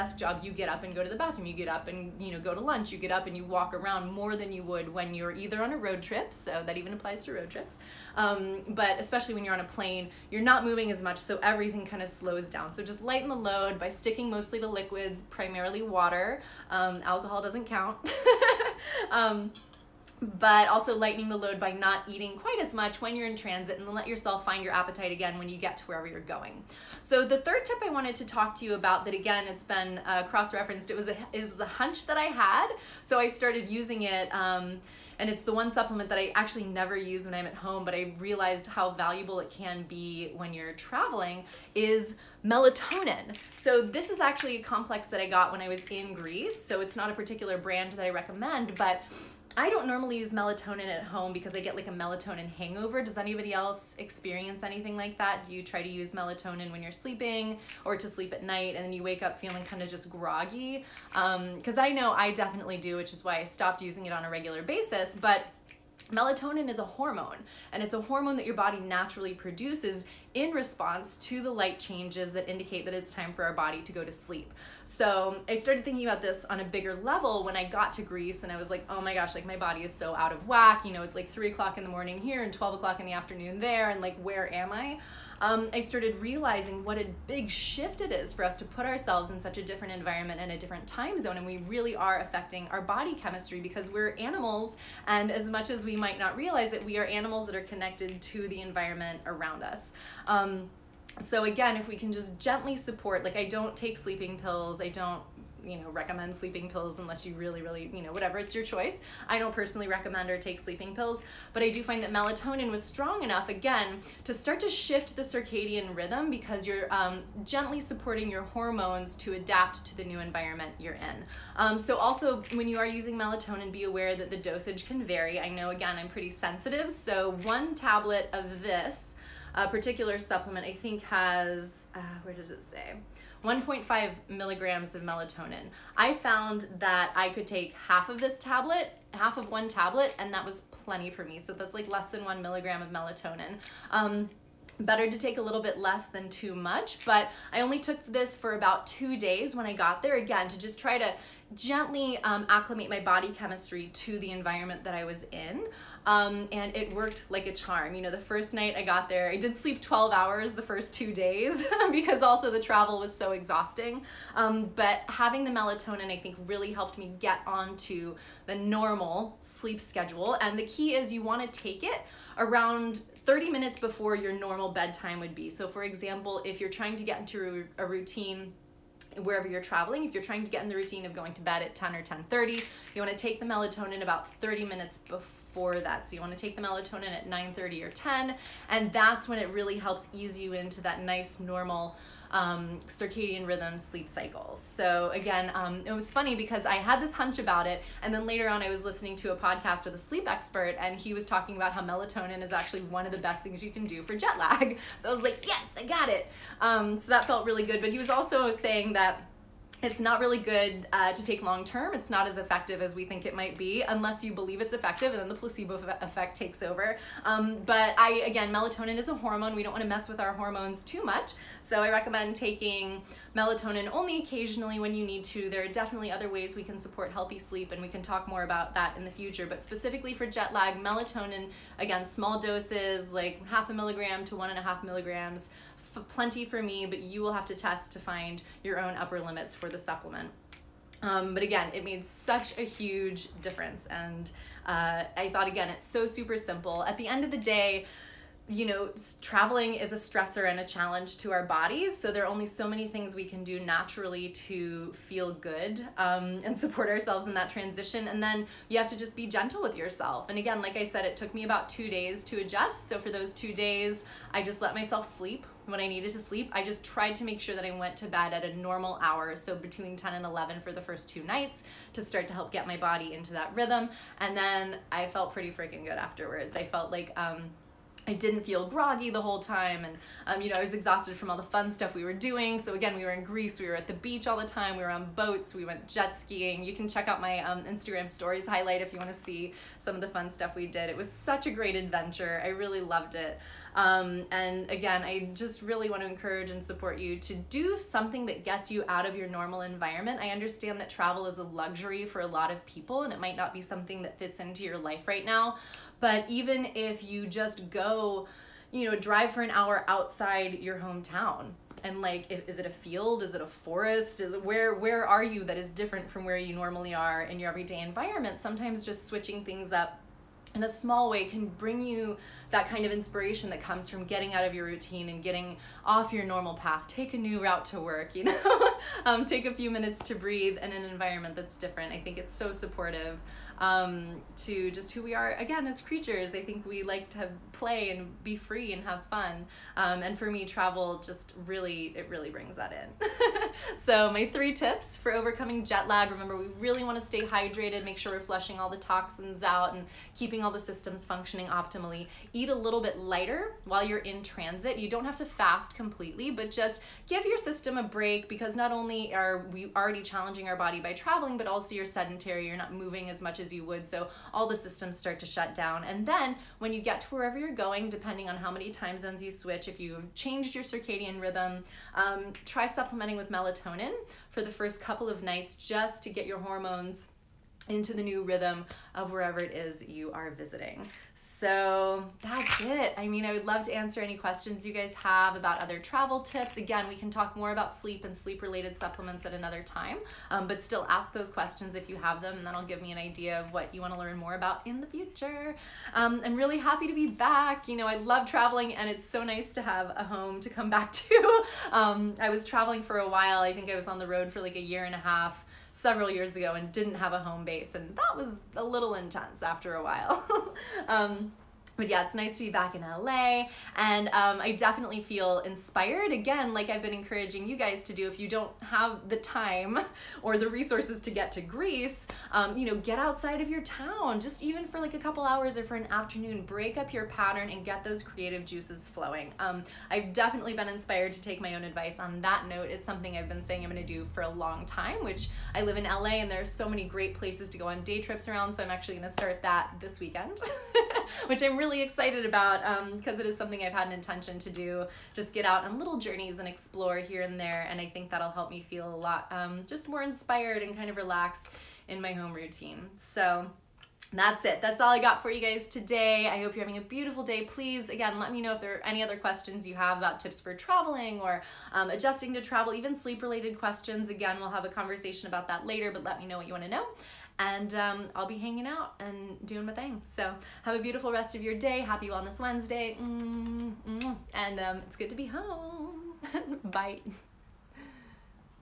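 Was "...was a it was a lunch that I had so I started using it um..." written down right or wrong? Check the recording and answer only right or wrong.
wrong.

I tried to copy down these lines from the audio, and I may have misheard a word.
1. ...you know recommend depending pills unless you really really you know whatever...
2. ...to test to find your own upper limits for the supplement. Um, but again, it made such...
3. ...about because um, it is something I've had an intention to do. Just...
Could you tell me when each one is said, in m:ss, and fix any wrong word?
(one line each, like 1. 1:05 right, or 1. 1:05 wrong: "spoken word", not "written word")
1. 1:45 wrong: "sleeping", not "depending"
2. 3:57 right
3. 7:22 right.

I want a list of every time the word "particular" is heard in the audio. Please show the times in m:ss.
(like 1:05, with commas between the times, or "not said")
0:47, 2:09.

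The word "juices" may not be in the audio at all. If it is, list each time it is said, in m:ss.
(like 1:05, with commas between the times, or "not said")
7:08.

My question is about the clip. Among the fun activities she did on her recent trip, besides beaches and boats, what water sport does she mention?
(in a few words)
jet skiing.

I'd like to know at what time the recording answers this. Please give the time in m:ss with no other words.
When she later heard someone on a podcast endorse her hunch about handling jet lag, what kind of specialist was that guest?
3:19.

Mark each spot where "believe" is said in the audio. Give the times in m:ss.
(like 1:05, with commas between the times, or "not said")
3:34.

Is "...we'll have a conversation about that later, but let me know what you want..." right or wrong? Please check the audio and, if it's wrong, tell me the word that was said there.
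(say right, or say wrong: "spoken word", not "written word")
right.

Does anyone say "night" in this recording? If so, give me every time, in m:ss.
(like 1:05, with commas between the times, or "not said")
0:58, 2:38, 4:31, 6:15.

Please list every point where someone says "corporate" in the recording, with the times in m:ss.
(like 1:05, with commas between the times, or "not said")
not said.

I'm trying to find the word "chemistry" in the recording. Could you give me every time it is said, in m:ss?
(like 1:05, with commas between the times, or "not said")
1:33, 2:33.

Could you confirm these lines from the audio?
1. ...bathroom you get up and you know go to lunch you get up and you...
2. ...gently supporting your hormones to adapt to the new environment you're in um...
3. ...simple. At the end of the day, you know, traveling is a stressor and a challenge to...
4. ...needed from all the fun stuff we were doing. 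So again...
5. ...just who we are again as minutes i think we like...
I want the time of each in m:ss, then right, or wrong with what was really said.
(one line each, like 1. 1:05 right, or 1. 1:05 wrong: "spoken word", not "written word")
1. 0:01 right
2. 1:57 right
3. 4:06 right
4. 4:40 wrong: "exhausted", not "needed"
5. 5:34 wrong: "creatures", not "minutes".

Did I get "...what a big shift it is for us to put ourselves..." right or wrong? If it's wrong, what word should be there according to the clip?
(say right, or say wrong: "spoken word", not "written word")
right.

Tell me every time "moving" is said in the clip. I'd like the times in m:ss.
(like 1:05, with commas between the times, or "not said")
0:10, 6:02.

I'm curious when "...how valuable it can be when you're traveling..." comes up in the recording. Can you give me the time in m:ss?
0:38.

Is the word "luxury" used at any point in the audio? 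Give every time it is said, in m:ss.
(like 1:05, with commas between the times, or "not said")
5:01.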